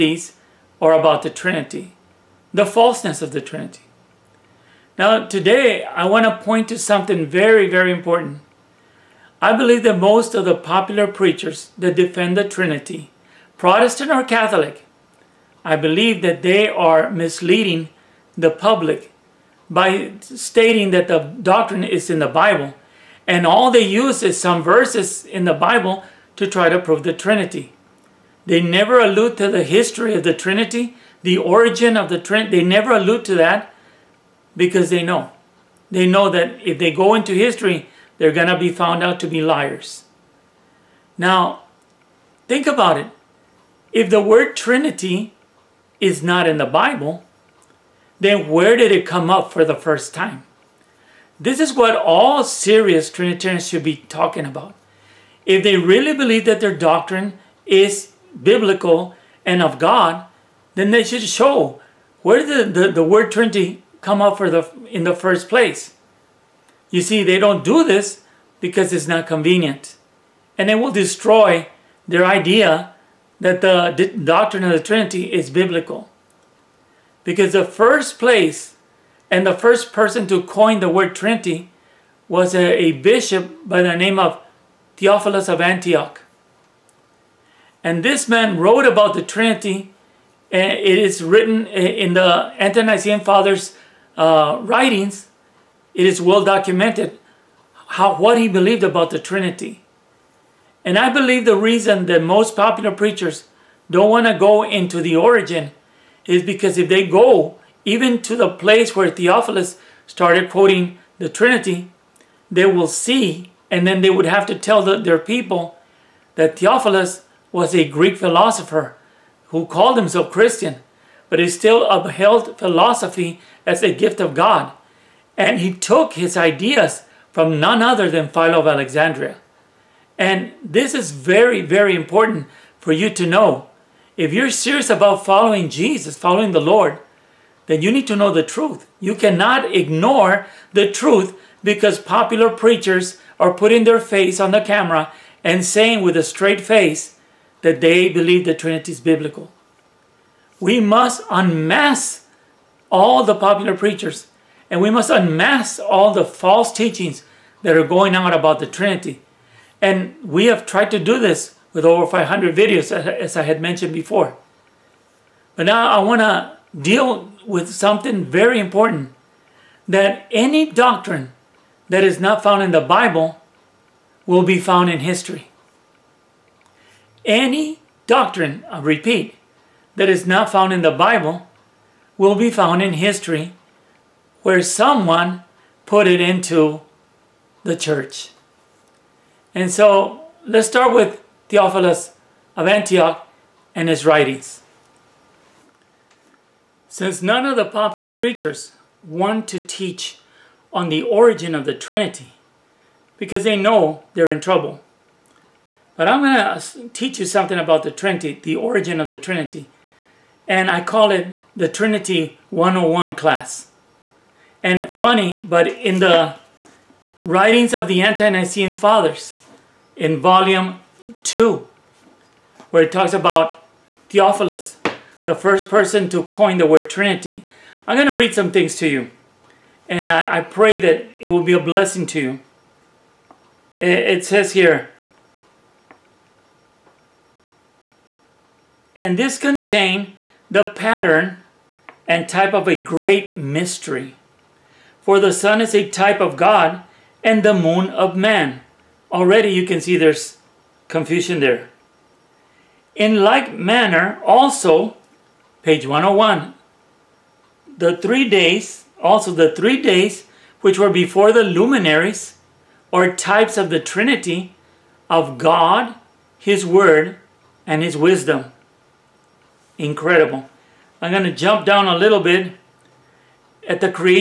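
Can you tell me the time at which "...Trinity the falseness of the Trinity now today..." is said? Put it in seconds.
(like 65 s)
1 s.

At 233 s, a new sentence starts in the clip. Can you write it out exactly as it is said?
It, it says here, and this contain the pattern and type of a great mystery.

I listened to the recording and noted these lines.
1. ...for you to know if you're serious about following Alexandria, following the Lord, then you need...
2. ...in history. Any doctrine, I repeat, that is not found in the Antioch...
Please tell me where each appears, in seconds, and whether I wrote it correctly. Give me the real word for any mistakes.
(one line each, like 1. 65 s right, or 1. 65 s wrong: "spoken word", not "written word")
1. 132 s wrong: "Jesus", not "Alexandria"
2. 174 s wrong: "Bible", not "Antioch".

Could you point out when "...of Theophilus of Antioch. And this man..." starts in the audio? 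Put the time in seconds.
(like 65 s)
84 s.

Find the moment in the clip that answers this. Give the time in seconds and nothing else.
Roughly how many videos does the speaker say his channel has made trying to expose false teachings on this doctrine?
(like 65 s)
161 s.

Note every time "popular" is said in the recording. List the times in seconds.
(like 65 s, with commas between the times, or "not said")
10 s, 102 s, 141 s, 153 s, 197 s.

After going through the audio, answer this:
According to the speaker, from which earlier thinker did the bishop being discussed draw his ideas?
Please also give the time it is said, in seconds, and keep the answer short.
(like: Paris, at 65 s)
Philo of Alexandria, at 128 s.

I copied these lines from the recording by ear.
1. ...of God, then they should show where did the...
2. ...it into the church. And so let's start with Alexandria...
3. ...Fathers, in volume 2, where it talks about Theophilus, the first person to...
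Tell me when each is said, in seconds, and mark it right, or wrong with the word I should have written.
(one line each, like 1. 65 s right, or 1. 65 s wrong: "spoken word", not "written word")
1. 59 s right
2. 186 s wrong: "Theophilus", not "Alexandria"
3. 218 s right.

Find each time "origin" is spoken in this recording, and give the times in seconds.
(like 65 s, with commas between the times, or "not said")
31 s, 105 s, 201 s, 208 s.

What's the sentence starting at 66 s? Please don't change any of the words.
You see, they don't do this because it's not convenient.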